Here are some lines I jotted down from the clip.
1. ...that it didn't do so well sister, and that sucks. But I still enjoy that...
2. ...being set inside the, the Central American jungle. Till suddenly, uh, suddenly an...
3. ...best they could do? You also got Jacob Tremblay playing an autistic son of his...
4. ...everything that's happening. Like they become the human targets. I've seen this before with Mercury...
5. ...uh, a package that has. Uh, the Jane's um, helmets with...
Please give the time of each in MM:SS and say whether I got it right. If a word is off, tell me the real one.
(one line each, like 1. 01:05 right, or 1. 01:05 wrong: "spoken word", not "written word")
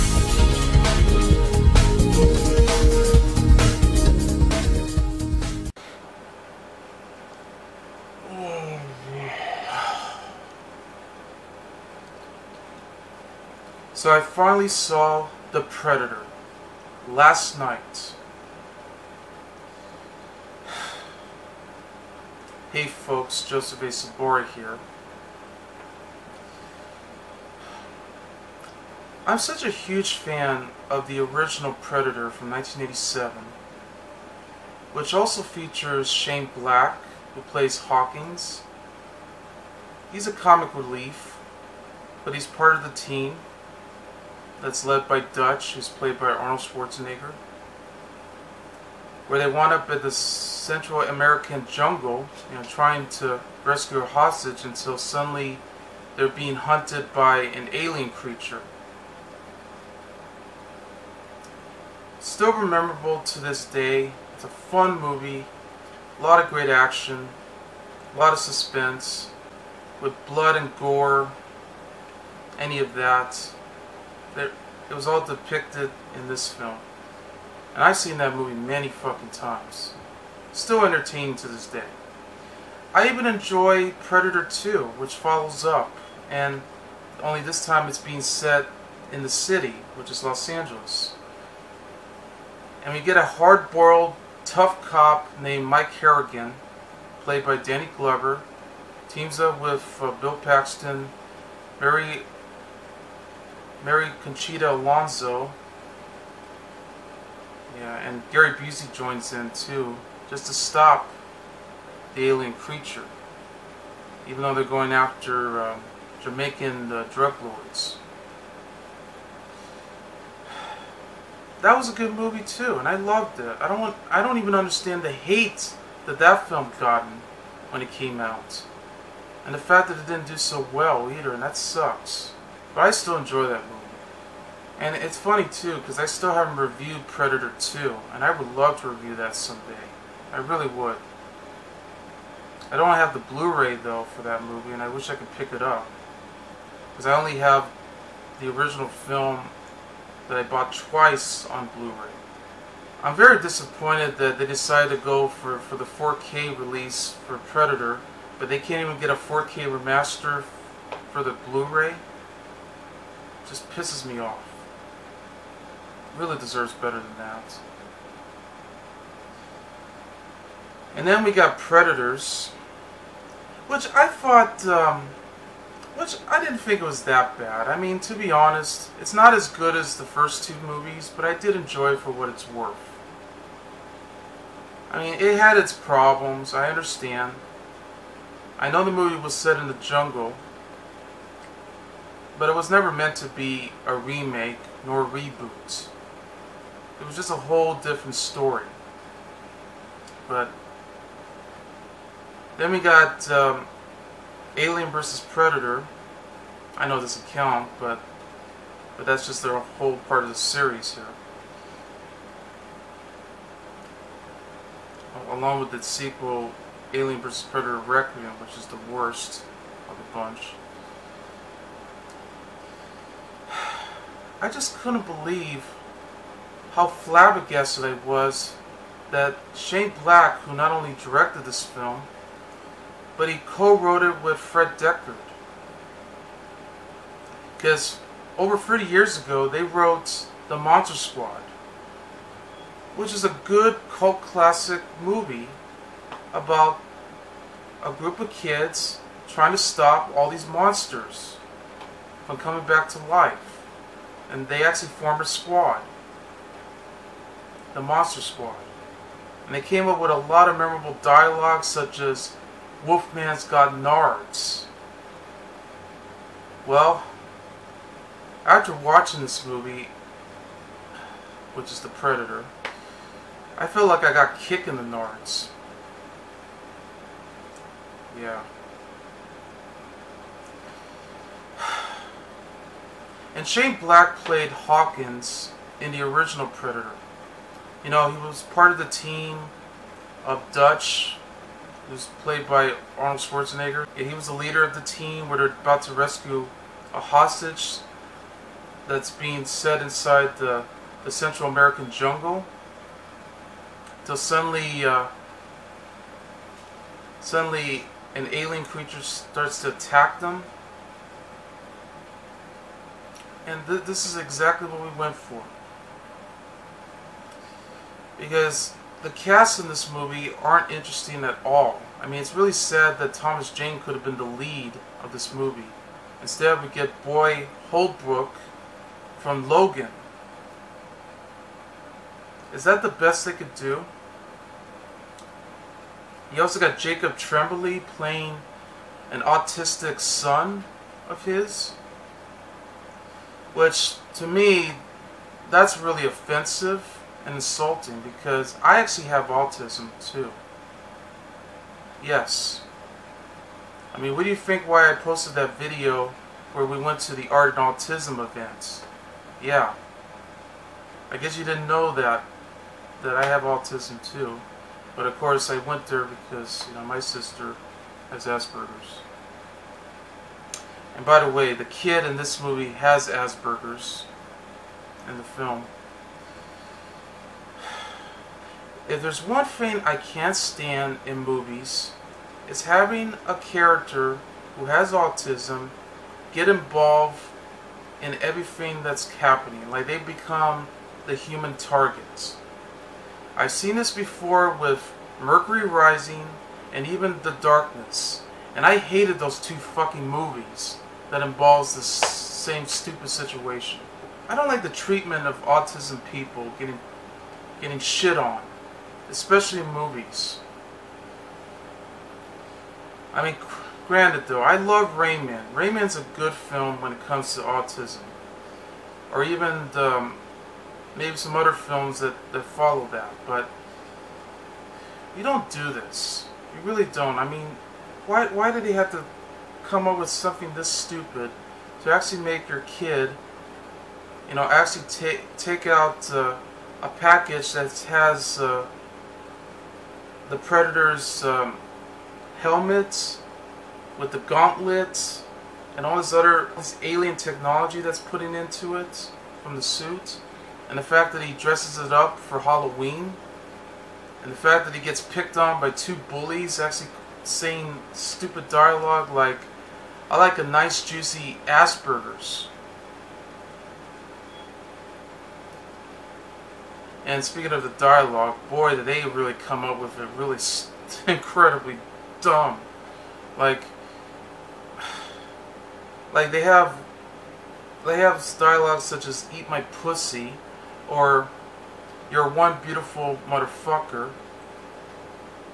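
1. 02:09 wrong: "either", not "sister"
2. 04:59 right
3. 05:32 right
4. 06:28 right
5. 07:16 wrong: "Predator", not "Jane".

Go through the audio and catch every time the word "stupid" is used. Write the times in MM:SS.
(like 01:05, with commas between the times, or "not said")
06:42, 07:10, 07:37.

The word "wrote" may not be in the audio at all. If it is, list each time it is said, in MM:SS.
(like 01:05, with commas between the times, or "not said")
03:53, 03:59.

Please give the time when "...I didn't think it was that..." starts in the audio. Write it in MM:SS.
02:56.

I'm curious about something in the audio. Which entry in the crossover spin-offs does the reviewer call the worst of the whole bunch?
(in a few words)
Alien vs. Predator Requiem.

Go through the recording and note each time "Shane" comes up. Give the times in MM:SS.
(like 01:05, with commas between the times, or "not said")
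00:36, 03:49, 04:43.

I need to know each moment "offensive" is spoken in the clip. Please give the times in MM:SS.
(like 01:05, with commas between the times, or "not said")
05:46.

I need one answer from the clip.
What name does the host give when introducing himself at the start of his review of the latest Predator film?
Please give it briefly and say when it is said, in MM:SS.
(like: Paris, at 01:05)
Joseph A. Sobora, at 00:23.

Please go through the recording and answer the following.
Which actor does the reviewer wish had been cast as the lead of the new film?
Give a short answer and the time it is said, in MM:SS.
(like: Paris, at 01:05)
Thomas Jane, at 05:23.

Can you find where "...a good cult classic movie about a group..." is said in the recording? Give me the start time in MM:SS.
04:03.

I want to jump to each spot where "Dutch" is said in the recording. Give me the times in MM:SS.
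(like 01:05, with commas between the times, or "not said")
00:45, 04:50.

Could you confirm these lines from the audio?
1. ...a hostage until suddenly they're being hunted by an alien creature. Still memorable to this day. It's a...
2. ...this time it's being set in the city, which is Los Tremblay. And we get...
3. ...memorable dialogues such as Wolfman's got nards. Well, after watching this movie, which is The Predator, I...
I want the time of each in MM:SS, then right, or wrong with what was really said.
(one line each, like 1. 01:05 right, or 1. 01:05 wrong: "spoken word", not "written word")
1. 00:53 right
2. 01:27 wrong: "Angeles", not "Tremblay"
3. 04:20 right.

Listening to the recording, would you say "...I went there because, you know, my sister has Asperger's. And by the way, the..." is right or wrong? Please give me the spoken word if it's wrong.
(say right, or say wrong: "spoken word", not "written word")
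right.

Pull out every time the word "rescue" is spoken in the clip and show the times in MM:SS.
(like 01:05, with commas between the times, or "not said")
00:53, 04:55.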